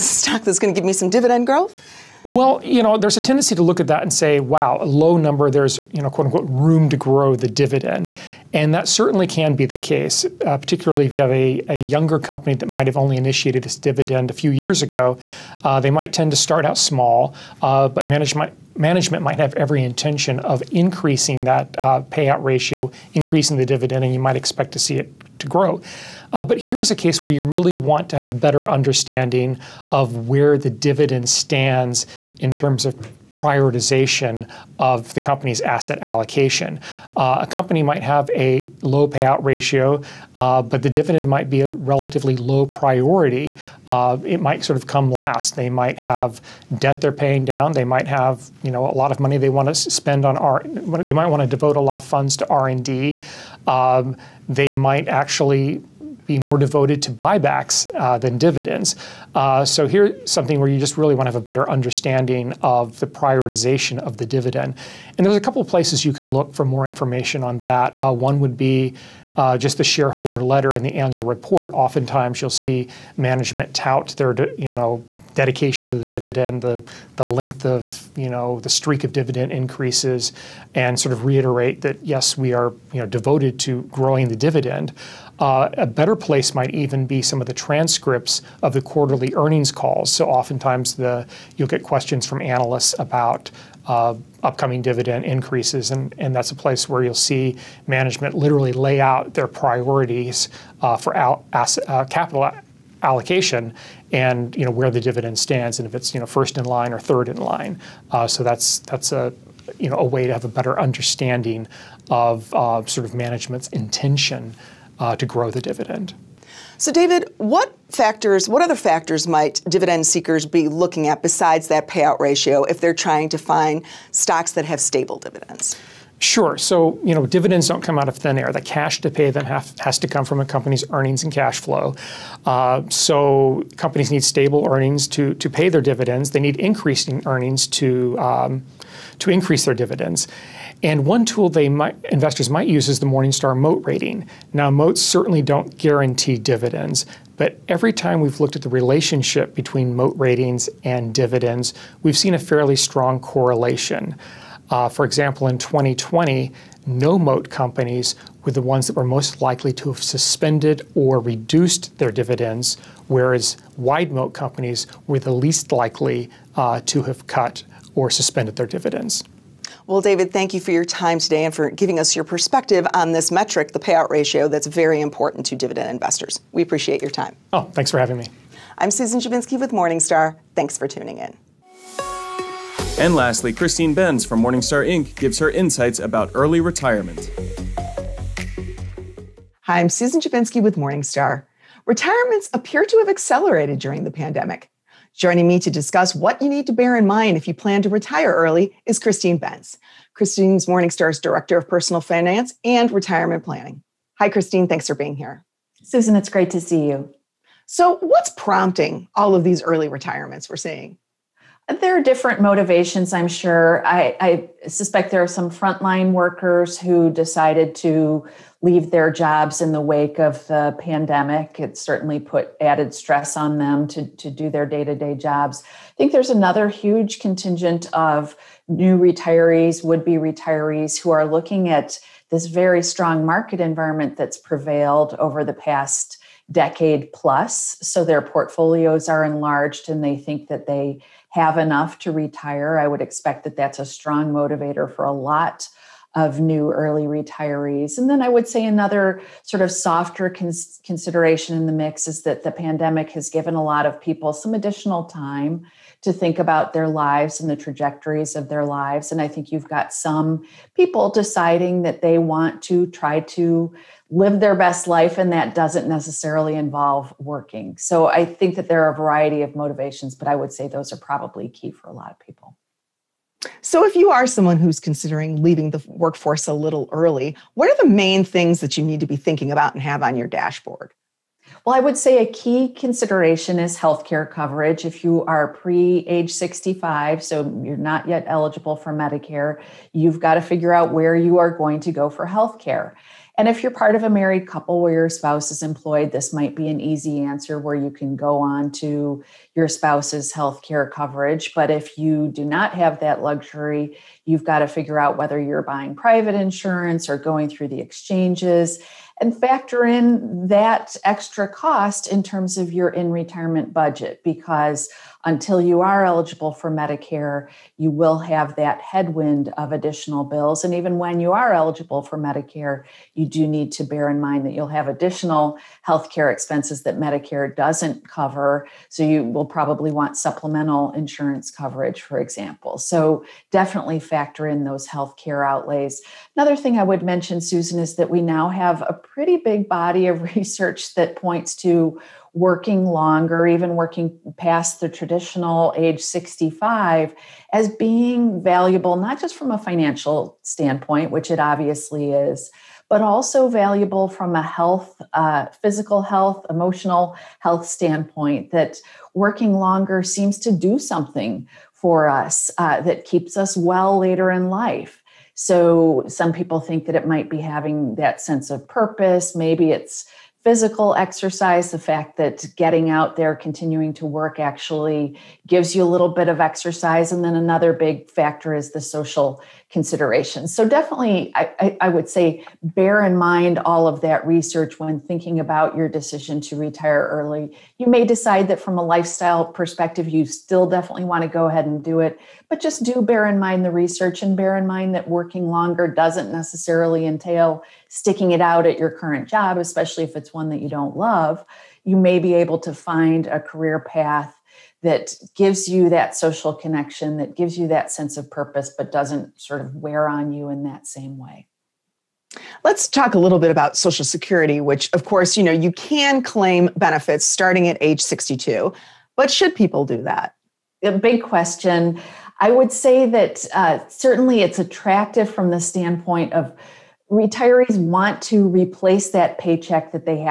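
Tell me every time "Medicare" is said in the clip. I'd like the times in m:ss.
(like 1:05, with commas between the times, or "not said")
4:48, 5:16, 5:22, 5:26.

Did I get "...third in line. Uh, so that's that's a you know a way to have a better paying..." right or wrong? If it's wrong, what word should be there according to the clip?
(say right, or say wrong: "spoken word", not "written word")
wrong: "understanding", not "paying".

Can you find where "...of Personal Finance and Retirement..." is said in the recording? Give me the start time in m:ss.
3:21.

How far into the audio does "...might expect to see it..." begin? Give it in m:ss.
0:24.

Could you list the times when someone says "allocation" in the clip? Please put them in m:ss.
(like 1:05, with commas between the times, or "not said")
0:35, 1:43.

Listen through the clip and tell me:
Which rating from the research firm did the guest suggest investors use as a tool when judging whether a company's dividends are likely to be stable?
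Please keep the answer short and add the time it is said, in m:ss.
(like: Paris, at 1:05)
Morningstar Moat rating, at 2:23.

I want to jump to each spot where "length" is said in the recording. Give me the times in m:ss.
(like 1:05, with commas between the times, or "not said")
1:17.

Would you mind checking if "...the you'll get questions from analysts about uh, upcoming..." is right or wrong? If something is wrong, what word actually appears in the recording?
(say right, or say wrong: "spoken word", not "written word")
right.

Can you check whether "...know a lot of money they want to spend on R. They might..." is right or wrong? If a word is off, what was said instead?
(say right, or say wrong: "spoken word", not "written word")
right.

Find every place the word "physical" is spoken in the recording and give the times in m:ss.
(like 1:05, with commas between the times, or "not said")
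5:55, 6:10.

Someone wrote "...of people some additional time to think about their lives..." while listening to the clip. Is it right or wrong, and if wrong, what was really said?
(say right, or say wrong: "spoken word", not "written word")
right.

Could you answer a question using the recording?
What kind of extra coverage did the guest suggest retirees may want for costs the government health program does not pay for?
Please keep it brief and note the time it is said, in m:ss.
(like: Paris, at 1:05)
supplemental insurance, at 5:30.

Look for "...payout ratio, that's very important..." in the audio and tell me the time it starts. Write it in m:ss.
2:53.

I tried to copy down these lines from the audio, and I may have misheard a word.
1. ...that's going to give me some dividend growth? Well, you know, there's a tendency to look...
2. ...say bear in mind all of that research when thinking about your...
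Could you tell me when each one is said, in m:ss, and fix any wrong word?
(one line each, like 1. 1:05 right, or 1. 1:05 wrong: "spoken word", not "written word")
1. 0:00 right
2. 6:22 right.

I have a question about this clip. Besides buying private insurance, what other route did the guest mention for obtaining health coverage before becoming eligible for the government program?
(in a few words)
the exchanges.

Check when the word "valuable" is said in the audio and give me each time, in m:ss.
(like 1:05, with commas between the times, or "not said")
5:48, 5:53.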